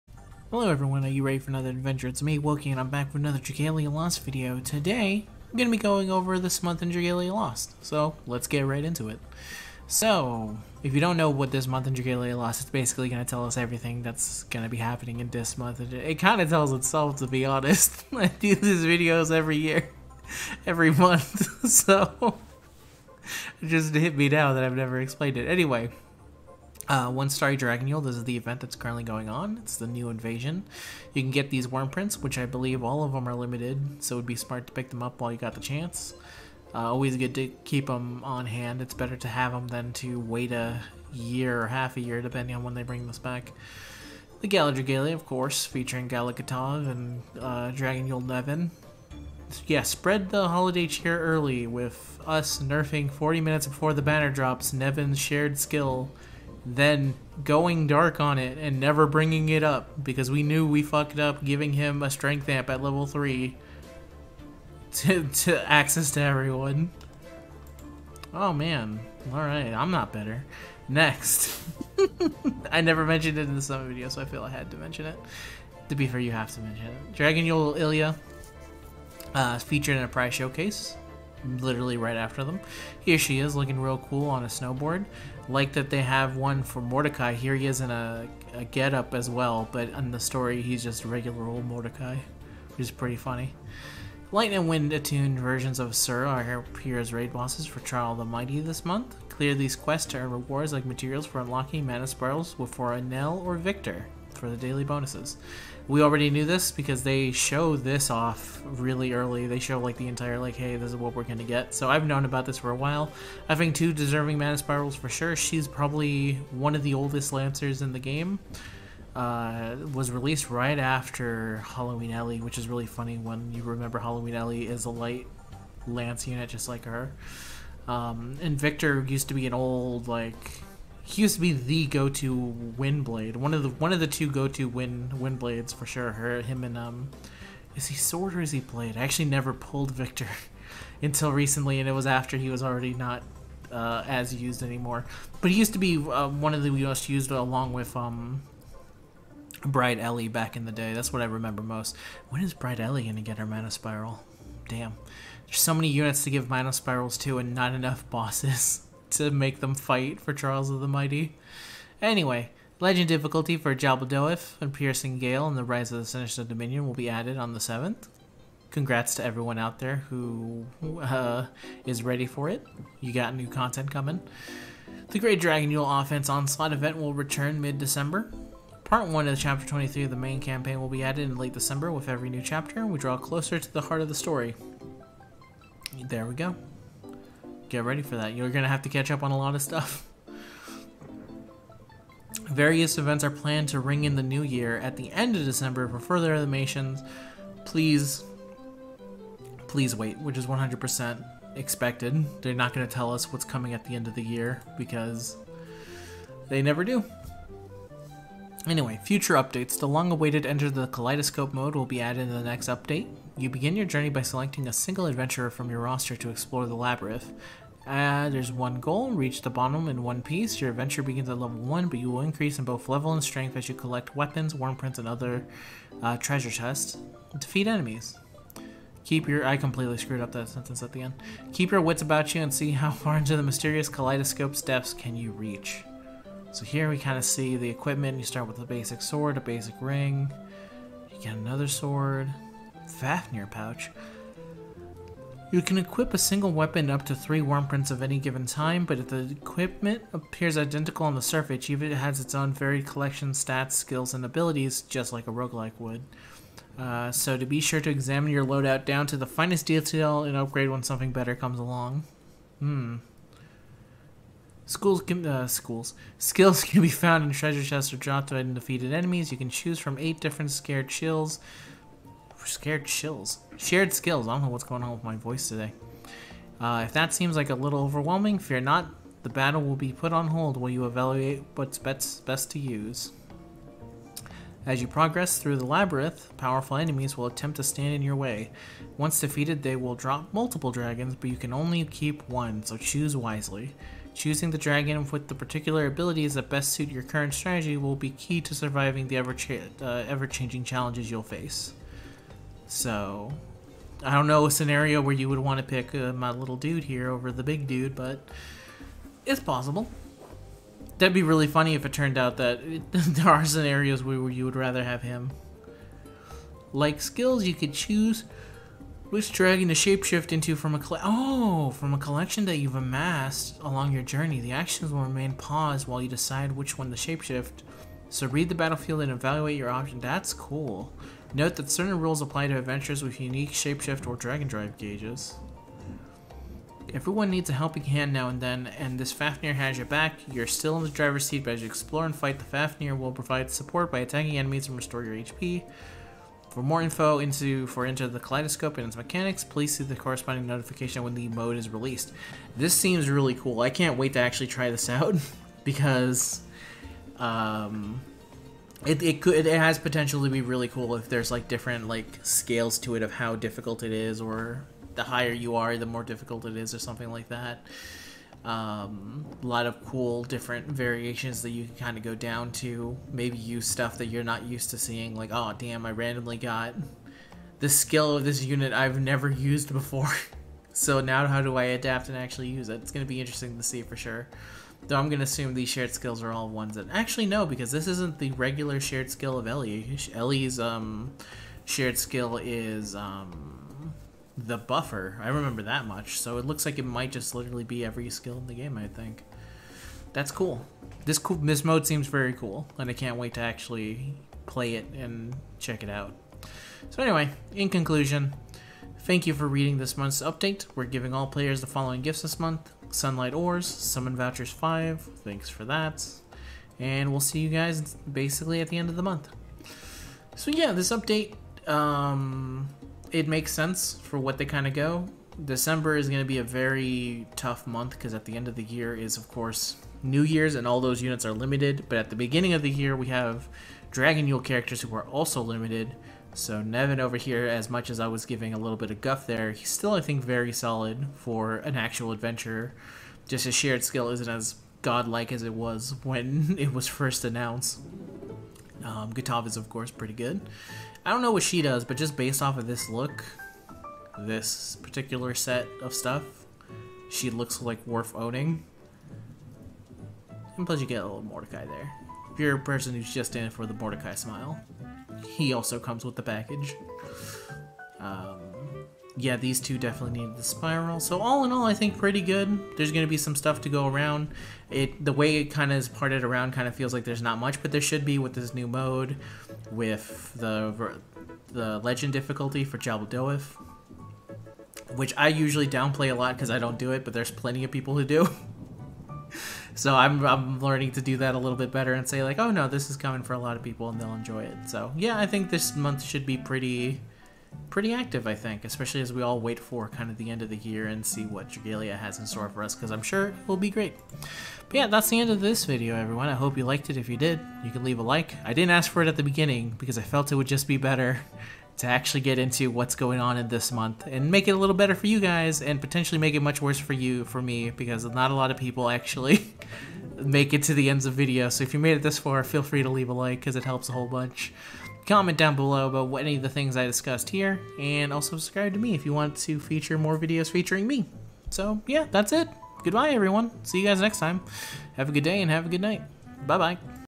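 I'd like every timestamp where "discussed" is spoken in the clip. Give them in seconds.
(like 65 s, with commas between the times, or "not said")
526 s.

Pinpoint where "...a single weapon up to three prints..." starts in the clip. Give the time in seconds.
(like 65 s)
246 s.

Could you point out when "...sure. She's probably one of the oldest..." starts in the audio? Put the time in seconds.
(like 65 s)
115 s.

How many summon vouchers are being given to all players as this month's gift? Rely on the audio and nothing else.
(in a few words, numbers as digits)
5.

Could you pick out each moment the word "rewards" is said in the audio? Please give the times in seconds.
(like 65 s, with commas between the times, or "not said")
100 s.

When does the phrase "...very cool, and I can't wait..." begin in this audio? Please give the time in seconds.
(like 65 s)
402 s.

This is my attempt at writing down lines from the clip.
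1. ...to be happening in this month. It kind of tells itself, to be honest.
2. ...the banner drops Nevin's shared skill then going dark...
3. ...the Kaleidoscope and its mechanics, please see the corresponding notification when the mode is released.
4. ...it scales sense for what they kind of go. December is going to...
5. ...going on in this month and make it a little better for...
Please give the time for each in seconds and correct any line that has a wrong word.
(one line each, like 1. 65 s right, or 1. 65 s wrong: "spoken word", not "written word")
1. 14 s right
2. 53 s right
3. 348 s right
4. 423 s wrong: "makes", not "scales"
5. 512 s right.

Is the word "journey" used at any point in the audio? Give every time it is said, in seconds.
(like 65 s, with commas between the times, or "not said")
213 s, 324 s.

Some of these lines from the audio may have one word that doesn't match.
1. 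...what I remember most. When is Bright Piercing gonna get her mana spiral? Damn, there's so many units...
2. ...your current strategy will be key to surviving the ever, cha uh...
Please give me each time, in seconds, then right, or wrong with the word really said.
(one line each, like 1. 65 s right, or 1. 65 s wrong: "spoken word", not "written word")
1. 151 s wrong: "Ellie", not "Piercing"
2. 296 s right.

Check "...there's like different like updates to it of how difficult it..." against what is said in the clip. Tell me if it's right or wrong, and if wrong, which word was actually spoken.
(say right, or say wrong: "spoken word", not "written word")
wrong: "scales", not "updates".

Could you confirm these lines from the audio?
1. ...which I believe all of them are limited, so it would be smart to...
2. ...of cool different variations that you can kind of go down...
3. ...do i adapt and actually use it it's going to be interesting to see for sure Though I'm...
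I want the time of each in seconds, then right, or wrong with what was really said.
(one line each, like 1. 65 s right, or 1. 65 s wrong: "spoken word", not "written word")
1. 32 s right
2. 369 s right
3. 381 s right.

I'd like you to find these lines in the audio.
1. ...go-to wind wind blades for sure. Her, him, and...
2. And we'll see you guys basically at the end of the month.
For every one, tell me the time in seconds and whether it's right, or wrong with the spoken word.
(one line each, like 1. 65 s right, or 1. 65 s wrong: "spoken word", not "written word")
1. 134 s right
2. 416 s right.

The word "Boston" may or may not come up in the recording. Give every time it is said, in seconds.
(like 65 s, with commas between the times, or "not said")
not said.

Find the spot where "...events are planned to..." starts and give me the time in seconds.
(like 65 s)
192 s.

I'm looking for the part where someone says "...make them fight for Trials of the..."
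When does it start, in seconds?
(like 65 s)
159 s.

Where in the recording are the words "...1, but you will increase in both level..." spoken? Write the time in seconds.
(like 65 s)
221 s.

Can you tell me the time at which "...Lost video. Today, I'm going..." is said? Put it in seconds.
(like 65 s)
3 s.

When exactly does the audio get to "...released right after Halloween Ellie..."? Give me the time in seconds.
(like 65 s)
120 s.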